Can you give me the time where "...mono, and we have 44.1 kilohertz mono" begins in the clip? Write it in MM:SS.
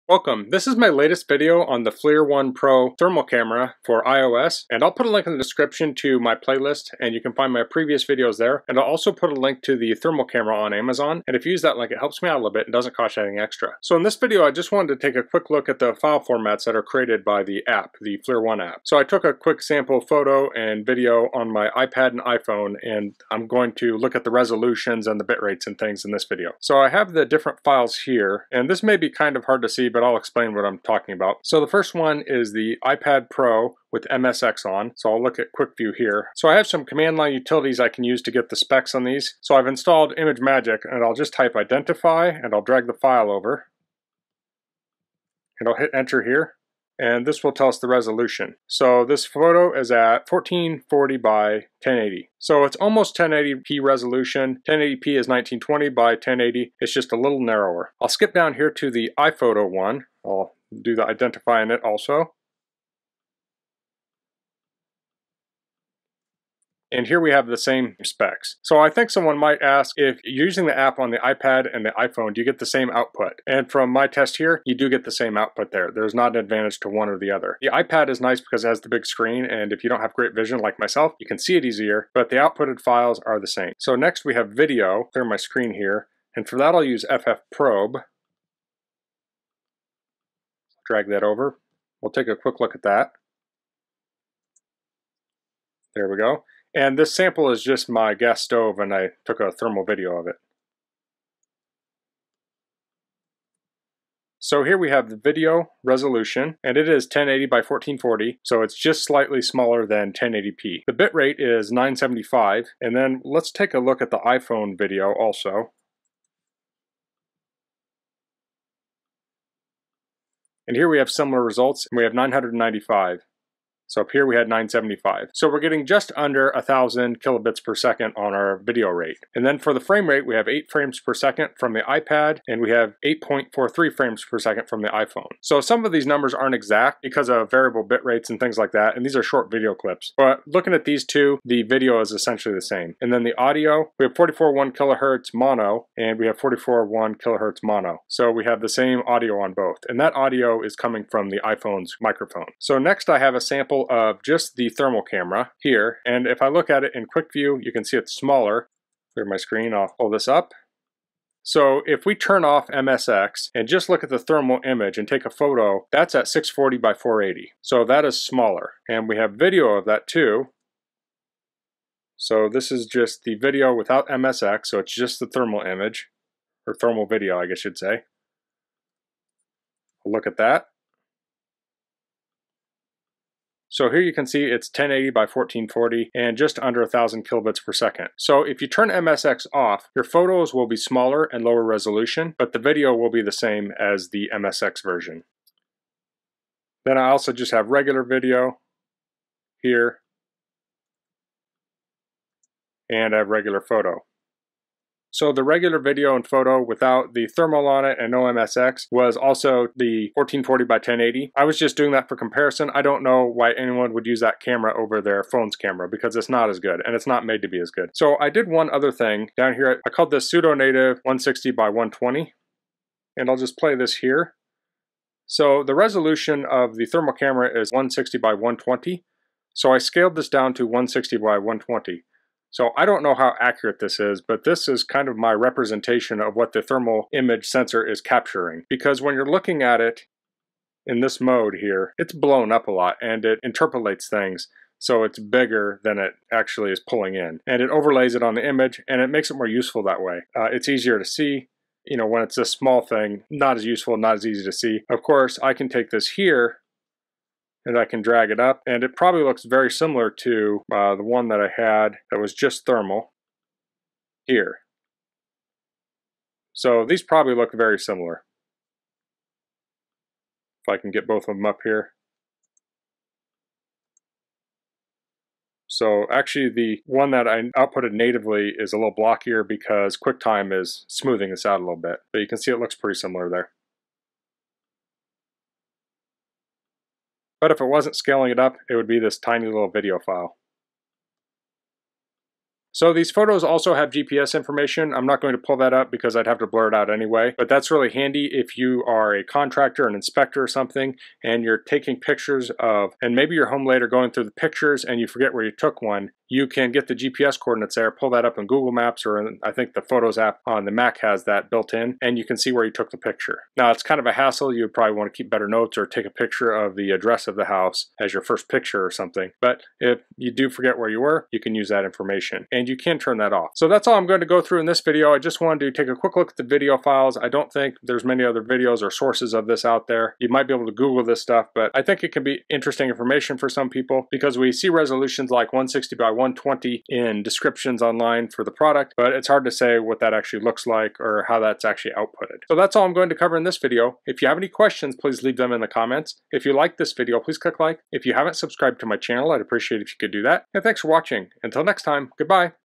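02:25.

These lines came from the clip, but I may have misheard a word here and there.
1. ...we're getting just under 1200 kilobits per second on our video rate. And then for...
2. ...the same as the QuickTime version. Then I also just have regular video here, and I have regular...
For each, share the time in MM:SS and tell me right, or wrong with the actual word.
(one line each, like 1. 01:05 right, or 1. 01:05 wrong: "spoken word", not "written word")
1. 02:05 wrong: "1000", not "1200"
2. 03:13 wrong: "MSX", not "QuickTime".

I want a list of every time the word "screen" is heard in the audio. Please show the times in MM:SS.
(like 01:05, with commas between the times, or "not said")
01:19, 01:25, 02:39.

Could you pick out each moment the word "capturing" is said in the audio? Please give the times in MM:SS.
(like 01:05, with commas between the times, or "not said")
03:58.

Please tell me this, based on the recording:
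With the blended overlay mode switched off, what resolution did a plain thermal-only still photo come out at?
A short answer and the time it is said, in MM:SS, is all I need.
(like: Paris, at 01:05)
640 by 480, at 02:46.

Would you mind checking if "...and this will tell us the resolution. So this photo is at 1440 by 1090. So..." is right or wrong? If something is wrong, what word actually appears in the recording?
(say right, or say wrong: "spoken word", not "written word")
wrong: "1080", not "1090".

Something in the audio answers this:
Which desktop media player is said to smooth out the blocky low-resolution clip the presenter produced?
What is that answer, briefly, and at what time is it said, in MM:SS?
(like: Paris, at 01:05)
QuickTime, at 04:39.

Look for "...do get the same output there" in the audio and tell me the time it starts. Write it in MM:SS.
01:14.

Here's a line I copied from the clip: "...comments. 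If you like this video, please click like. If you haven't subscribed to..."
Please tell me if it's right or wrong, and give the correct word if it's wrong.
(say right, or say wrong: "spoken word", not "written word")
right.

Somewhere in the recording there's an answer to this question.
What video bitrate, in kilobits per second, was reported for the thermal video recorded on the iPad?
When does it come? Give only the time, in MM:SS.
01:50.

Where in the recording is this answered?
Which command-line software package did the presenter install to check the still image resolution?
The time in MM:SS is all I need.
00:40.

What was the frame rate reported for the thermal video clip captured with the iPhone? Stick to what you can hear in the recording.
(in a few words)
8.43 frames per second.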